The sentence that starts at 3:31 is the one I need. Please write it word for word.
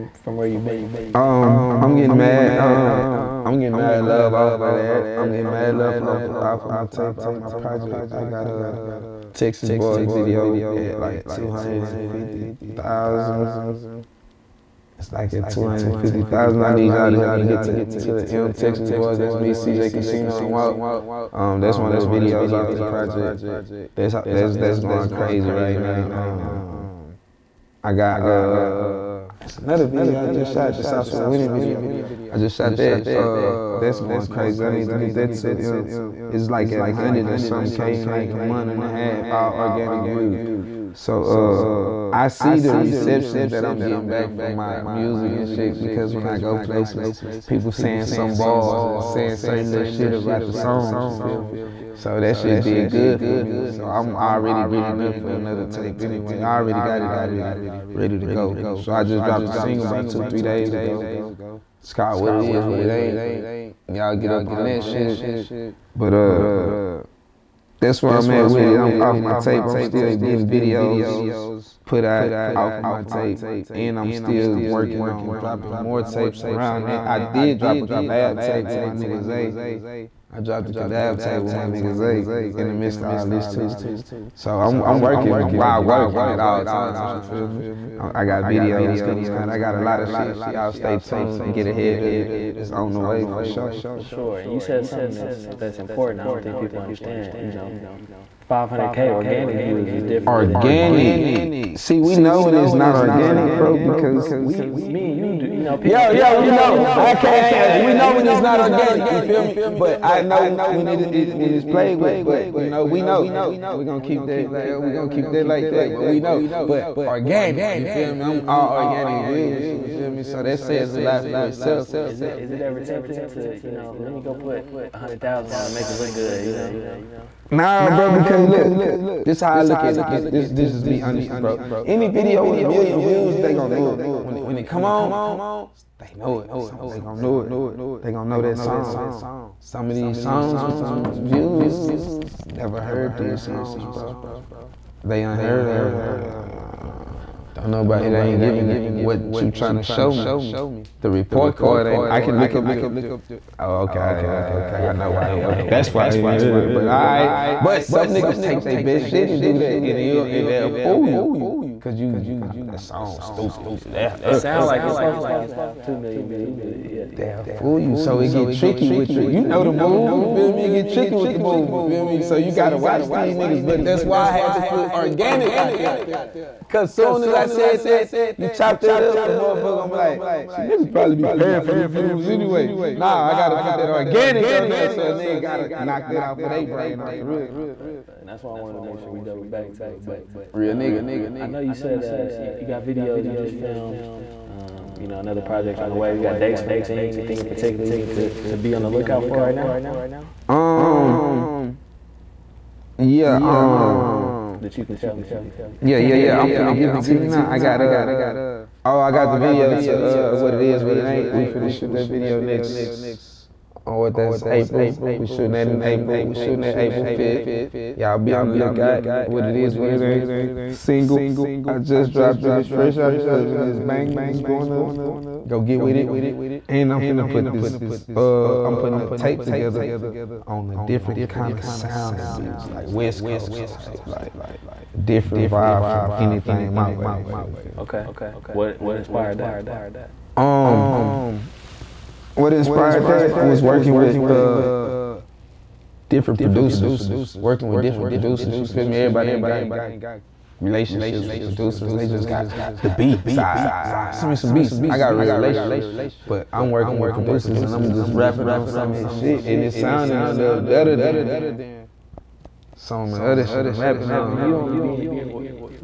We finna shoot that video next on oh, what that's April.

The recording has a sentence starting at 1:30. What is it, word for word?
Y'all stay tuned, get ahead of it.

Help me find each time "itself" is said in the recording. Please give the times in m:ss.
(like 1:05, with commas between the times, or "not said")
2:01.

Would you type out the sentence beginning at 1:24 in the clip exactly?
So I'm, I'm working while working at all times, you feel me?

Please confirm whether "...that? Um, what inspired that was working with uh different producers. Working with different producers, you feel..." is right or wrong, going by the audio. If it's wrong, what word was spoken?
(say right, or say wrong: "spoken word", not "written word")
right.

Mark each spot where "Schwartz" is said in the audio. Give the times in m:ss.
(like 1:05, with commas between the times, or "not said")
not said.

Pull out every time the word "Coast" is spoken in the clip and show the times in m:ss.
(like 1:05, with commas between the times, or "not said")
3:53.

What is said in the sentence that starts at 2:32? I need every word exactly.
I can look up the Oh, okay, uh, okay.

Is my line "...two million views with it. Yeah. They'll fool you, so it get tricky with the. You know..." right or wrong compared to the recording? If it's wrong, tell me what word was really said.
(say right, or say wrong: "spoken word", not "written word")
right.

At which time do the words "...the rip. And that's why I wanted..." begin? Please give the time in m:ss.
3:07.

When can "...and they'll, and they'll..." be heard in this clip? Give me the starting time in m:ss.
2:39.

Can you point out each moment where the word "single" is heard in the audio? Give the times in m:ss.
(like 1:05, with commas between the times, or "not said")
0:59, 3:40.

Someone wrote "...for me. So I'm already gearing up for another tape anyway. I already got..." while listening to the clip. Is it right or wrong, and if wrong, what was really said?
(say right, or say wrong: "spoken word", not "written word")
right.